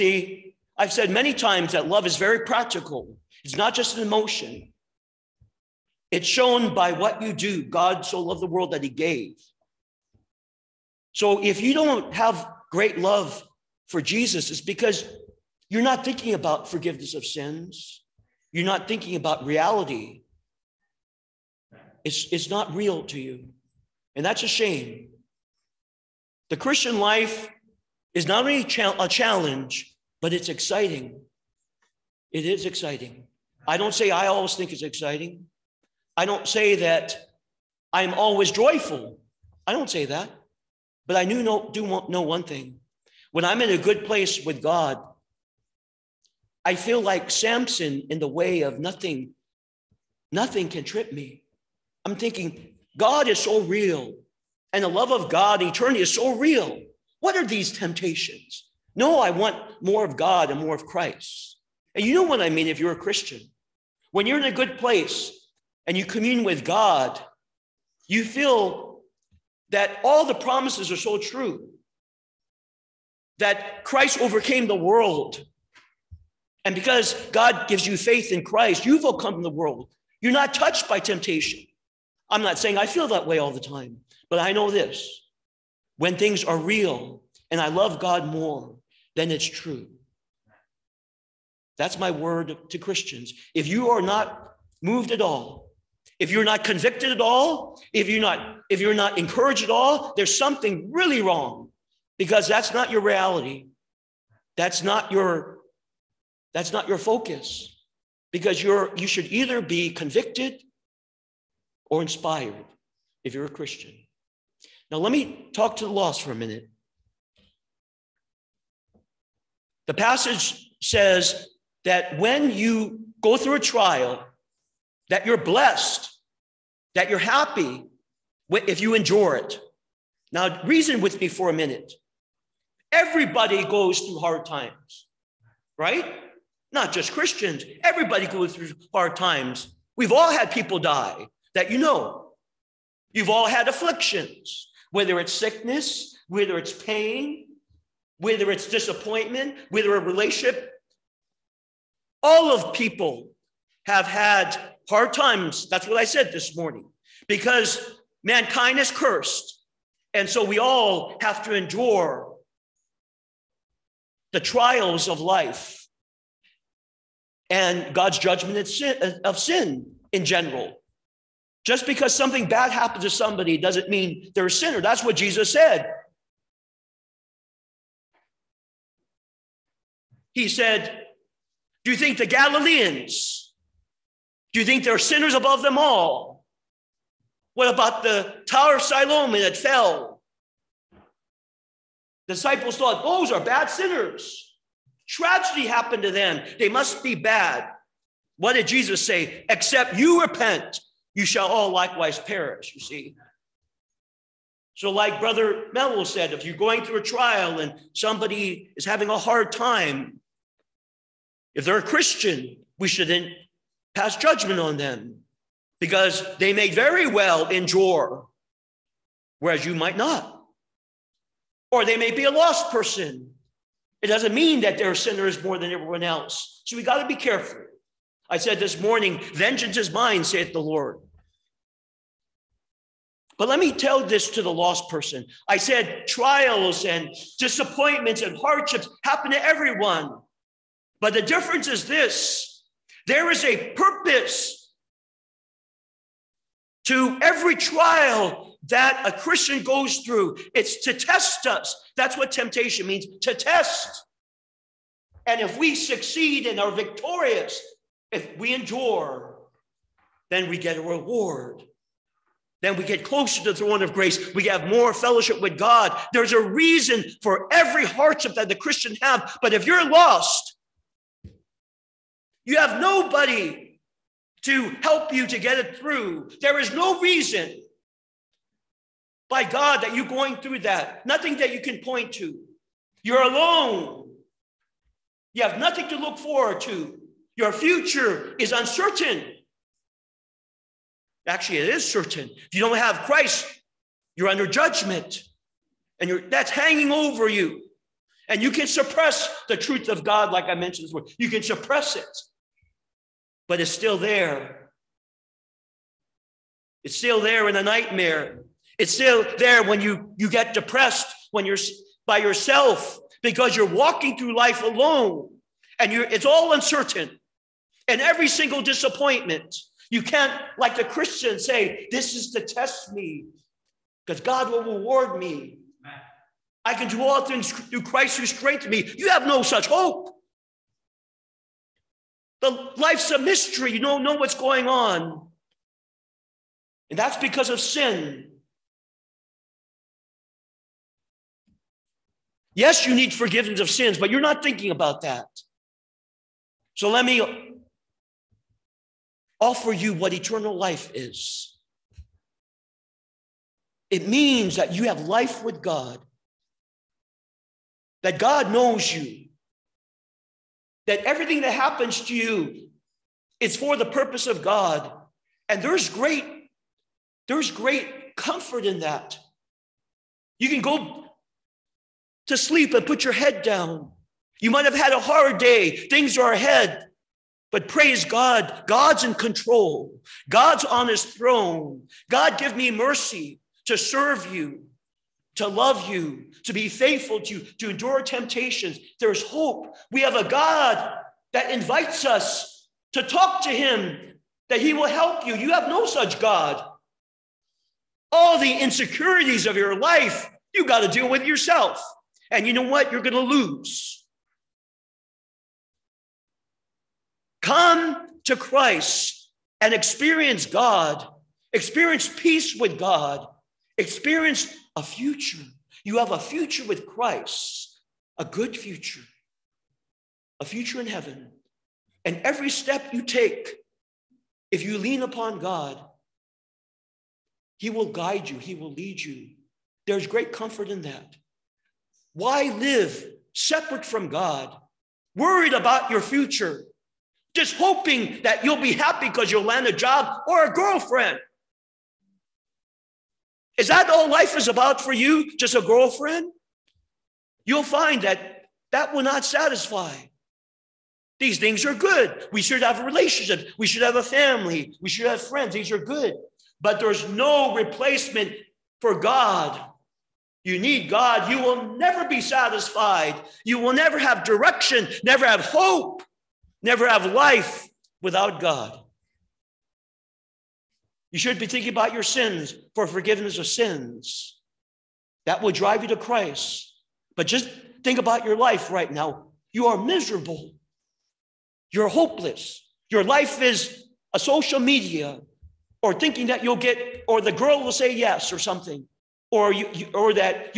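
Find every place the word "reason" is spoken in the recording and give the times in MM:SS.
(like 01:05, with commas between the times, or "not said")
02:10, 04:26, 04:37.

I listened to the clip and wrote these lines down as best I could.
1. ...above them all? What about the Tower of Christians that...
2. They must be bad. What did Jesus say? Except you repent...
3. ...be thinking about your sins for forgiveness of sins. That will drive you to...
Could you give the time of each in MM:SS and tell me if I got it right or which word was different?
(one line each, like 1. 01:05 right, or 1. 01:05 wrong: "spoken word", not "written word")
1. 03:05 wrong: "Siloam", not "Christians"
2. 03:16 right
3. 07:51 right.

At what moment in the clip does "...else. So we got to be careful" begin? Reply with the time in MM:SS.
03:46.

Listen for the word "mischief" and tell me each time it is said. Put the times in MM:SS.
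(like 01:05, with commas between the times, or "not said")
not said.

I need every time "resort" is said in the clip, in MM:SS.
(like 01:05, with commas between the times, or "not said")
not said.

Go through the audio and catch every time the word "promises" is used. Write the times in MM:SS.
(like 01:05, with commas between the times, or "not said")
01:10.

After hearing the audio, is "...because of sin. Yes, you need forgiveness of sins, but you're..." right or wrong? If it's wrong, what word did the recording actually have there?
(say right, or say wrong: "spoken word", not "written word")
right.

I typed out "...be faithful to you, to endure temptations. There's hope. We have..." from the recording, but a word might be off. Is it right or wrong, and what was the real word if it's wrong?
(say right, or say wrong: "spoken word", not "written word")
right.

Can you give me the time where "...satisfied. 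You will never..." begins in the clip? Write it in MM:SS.
07:42.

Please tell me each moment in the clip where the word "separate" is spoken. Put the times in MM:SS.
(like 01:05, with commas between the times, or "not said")
07:13.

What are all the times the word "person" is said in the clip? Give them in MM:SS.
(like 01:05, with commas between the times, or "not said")
03:42, 03:54.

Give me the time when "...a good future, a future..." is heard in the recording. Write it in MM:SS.
06:58.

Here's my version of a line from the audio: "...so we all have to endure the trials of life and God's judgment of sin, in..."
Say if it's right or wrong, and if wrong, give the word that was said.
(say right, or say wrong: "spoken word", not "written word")
right.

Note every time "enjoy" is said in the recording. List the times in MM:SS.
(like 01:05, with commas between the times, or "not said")
not said.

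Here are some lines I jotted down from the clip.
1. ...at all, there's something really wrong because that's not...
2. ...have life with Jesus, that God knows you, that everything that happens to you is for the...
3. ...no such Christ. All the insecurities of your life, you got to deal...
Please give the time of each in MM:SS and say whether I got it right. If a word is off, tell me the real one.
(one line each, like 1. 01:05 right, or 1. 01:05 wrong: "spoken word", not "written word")
1. 01:39 right
2. 05:54 wrong: "God", not "Jesus"
3. 06:35 wrong: "God", not "Christ".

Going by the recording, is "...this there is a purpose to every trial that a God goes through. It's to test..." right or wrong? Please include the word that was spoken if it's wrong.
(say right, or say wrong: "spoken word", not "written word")
wrong: "Christian", not "God".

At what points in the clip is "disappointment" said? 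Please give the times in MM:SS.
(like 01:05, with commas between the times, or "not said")
02:28, 03:57, 05:18.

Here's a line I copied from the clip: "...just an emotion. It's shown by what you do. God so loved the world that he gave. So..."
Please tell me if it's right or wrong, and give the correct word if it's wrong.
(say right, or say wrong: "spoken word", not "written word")
right.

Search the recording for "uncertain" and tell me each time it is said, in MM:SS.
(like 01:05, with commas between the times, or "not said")
04:48, 05:16.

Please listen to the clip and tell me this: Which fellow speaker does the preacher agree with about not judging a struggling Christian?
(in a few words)
Brother Melo.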